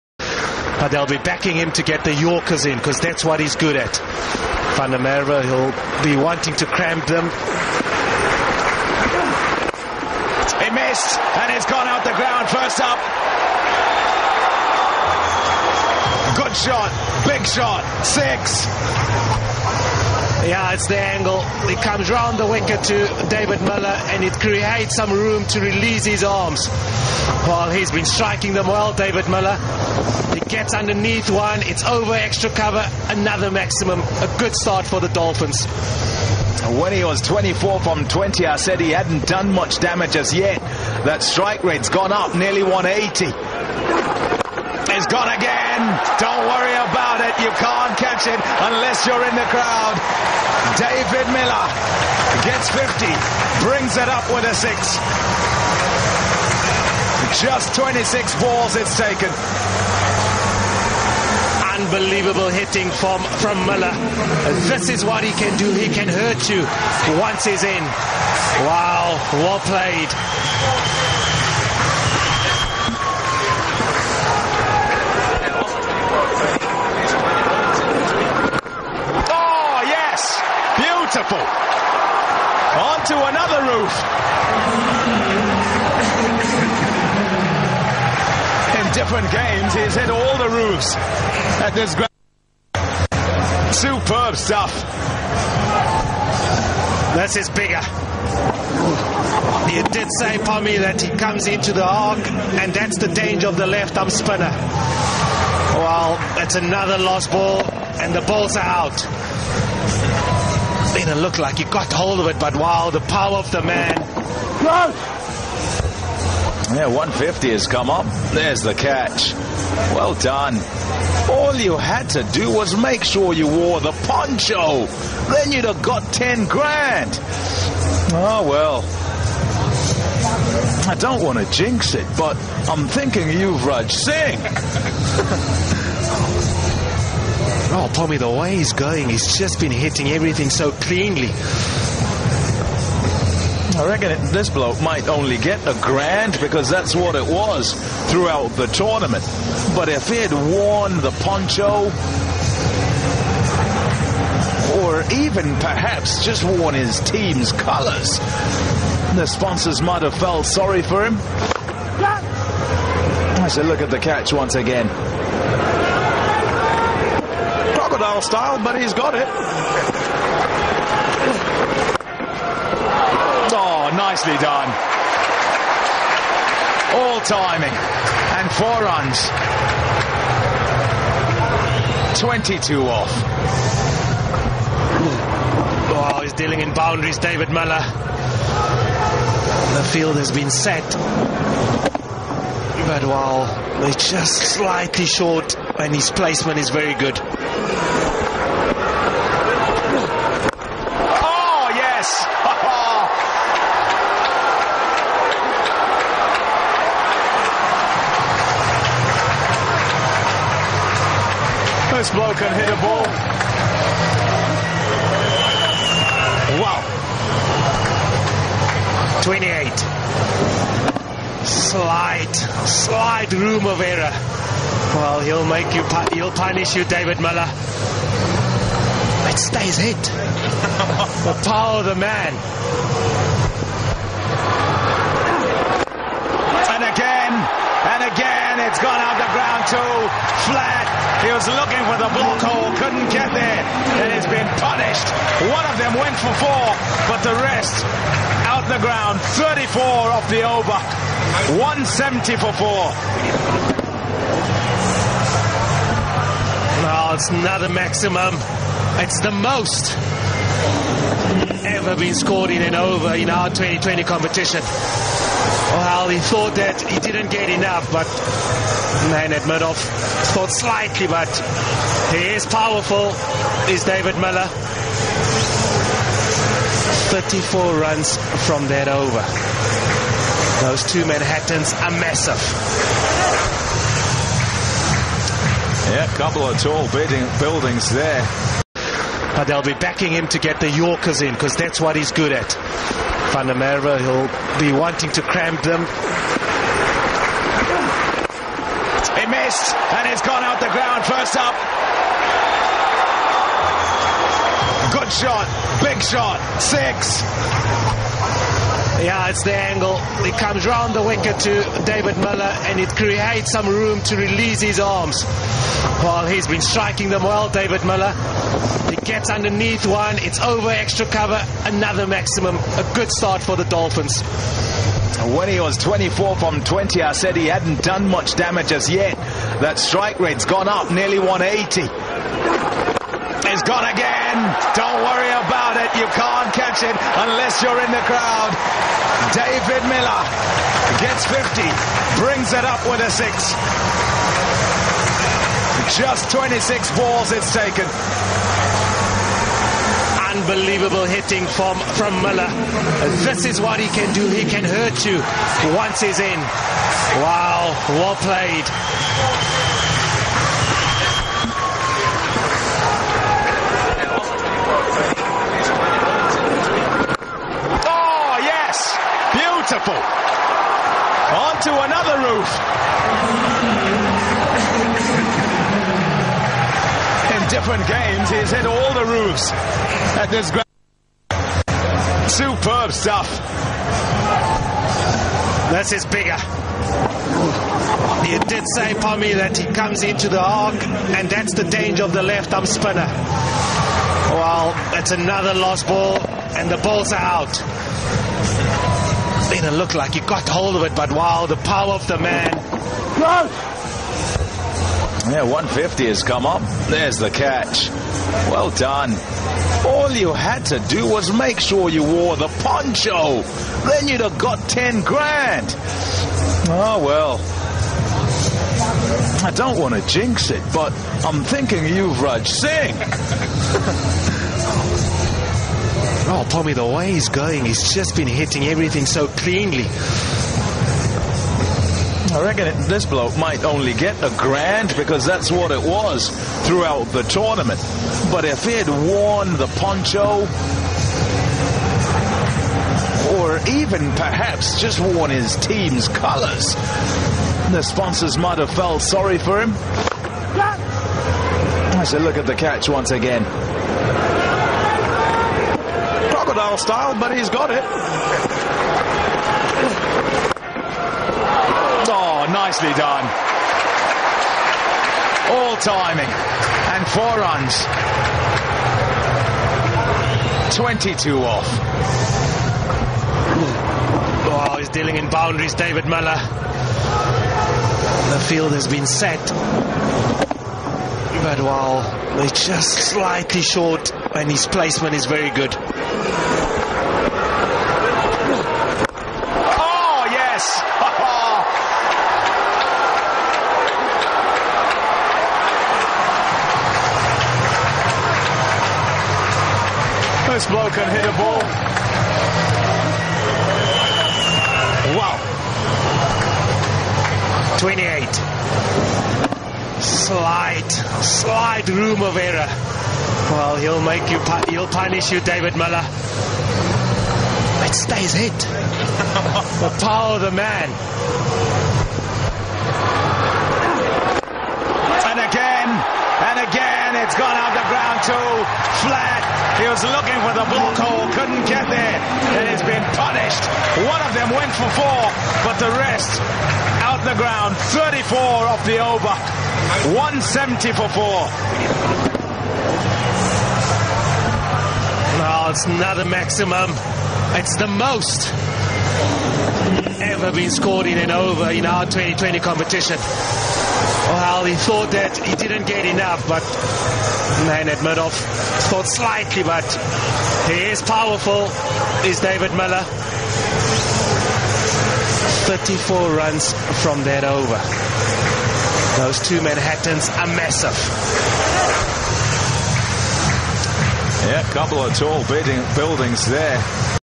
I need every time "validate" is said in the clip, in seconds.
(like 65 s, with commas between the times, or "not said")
not said.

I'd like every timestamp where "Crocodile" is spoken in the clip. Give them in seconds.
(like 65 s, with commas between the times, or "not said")
167 s, 456 s.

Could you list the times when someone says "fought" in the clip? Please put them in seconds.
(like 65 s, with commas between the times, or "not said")
not said.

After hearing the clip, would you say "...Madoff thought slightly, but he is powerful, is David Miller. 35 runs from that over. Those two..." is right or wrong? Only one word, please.
wrong.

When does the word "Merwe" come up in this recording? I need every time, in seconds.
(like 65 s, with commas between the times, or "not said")
4 s, 293 s.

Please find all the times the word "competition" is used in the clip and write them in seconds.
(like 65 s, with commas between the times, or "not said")
264 s, 552 s.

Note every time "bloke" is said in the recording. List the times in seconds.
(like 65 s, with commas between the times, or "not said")
144 s, 433 s.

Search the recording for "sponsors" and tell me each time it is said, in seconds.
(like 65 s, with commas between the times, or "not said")
159 s, 447 s.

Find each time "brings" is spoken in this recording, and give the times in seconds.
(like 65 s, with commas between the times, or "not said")
53 s, 342 s.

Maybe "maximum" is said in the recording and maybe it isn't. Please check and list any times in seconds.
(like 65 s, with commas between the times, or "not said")
33 s, 257 s, 322 s, 546 s.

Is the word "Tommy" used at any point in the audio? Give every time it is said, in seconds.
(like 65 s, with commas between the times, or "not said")
137 s, 426 s.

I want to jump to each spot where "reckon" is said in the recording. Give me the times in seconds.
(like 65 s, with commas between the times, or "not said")
143 s, 432 s.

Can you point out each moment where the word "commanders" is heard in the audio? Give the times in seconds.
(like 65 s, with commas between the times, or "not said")
not said.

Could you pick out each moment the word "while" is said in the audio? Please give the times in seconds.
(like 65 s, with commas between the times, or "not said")
193 s, 481 s.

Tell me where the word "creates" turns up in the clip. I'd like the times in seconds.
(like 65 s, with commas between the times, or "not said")
24 s, 312 s.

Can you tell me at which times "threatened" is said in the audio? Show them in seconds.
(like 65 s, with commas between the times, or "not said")
not said.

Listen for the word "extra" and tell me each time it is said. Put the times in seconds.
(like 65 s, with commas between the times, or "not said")
32 s, 320 s.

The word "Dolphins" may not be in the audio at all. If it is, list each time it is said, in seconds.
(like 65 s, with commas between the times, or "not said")
35 s, 323 s.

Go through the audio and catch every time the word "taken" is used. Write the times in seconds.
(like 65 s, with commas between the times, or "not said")
58 s, 347 s.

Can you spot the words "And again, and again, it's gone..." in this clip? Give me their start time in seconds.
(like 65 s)
525 s.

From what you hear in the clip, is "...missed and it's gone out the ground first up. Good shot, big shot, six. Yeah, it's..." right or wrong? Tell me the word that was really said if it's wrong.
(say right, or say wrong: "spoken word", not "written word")
right.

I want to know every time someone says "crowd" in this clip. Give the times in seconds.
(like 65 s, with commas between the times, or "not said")
49 s, 338 s.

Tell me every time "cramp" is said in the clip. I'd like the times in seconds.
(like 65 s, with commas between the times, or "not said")
6 s, 295 s.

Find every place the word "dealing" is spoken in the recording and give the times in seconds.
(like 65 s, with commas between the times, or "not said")
186 s, 474 s.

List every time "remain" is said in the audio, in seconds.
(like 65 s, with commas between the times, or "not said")
not said.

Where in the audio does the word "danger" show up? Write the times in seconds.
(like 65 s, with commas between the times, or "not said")
103 s, 391 s.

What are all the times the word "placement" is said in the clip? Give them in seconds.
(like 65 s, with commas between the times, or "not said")
196 s, 484 s.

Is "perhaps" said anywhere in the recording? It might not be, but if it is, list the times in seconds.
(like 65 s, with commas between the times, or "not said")
155 s, 444 s.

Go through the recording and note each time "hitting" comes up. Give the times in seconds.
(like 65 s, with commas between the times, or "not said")
62 s, 139 s, 351 s, 428 s.